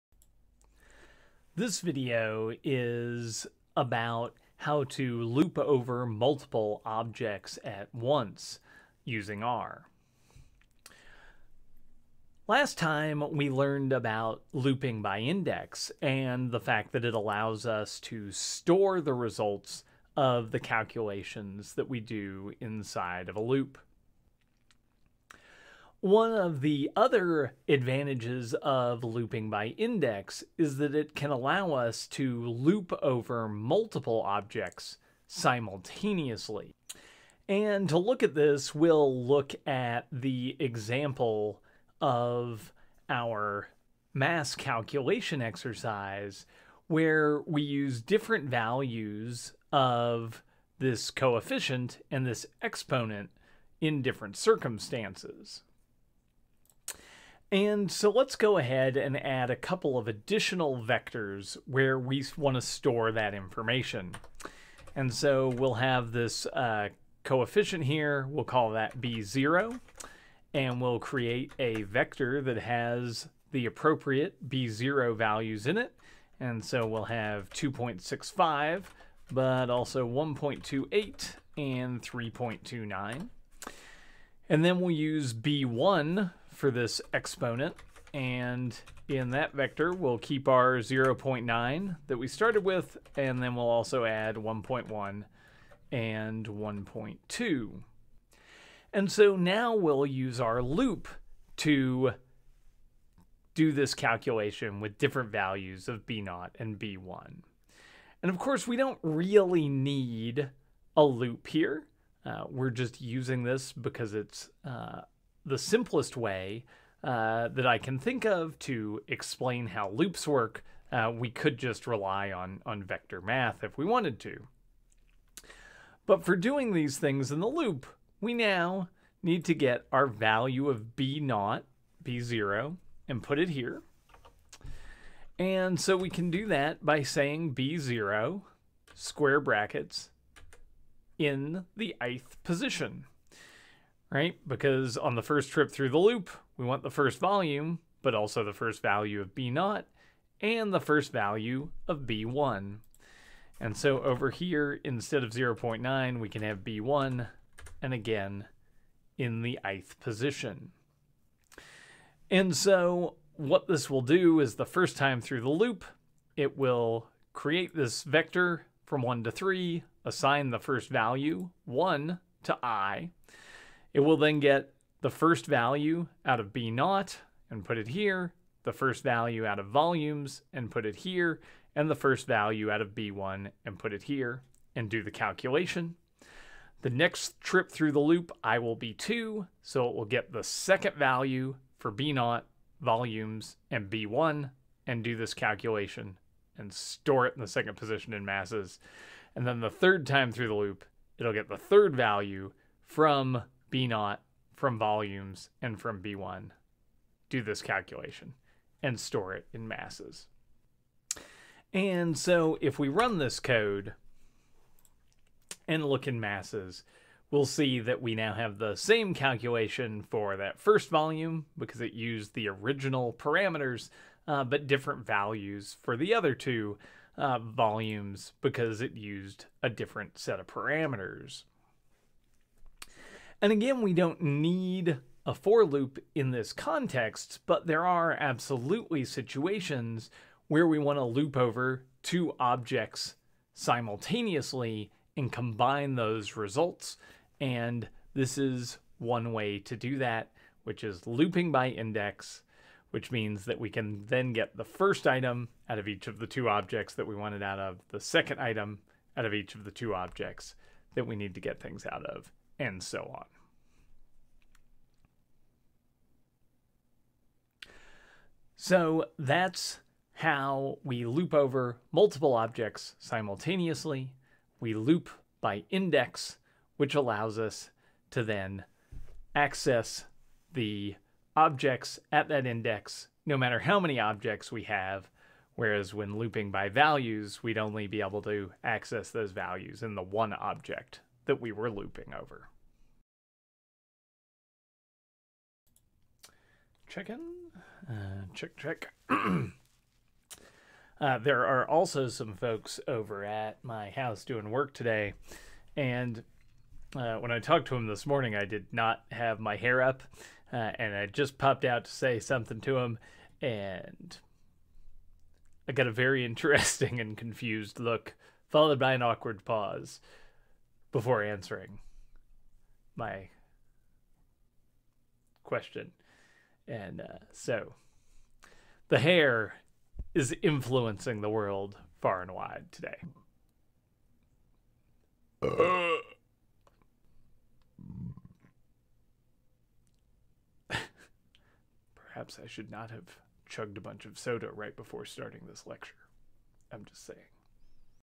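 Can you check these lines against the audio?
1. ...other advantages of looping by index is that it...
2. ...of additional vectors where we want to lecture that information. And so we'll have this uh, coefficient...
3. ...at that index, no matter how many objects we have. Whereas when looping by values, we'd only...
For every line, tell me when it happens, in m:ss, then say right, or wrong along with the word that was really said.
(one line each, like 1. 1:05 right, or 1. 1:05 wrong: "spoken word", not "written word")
1. 0:26 right
2. 0:59 wrong: "store", not "lecture"
3. 4:42 right.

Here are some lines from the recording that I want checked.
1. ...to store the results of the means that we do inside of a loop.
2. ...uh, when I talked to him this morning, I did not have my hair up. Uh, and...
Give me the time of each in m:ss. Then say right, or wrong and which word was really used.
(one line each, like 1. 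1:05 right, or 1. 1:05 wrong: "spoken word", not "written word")
1. 0:18 wrong: "calculations", not "means"
2. 5:06 right.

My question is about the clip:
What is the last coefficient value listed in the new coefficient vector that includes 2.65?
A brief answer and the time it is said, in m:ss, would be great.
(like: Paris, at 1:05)
3.29, at 1:22.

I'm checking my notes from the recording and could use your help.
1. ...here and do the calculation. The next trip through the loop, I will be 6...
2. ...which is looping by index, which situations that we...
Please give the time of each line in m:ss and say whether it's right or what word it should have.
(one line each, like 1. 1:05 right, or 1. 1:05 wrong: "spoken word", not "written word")
1. 3:04 wrong: "2", not "6"
2. 4:10 wrong: "means", not "situations".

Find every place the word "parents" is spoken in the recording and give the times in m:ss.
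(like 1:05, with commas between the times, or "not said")
not said.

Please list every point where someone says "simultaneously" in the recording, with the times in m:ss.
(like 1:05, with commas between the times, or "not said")
0:35, 4:03, 4:32.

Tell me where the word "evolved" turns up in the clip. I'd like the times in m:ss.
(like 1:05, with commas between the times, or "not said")
not said.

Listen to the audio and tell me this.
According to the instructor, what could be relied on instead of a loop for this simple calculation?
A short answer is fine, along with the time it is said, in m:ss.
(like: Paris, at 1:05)
vector math, at 2:02.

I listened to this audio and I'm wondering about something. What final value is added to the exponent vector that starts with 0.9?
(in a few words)
1.2.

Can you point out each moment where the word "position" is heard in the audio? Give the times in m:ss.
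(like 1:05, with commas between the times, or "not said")
2:22, 2:39, 3:17.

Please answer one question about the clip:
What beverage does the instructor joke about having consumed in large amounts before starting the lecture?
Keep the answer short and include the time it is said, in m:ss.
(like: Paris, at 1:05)
soda, at 5:44.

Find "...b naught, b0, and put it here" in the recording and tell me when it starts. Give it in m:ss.
2:10.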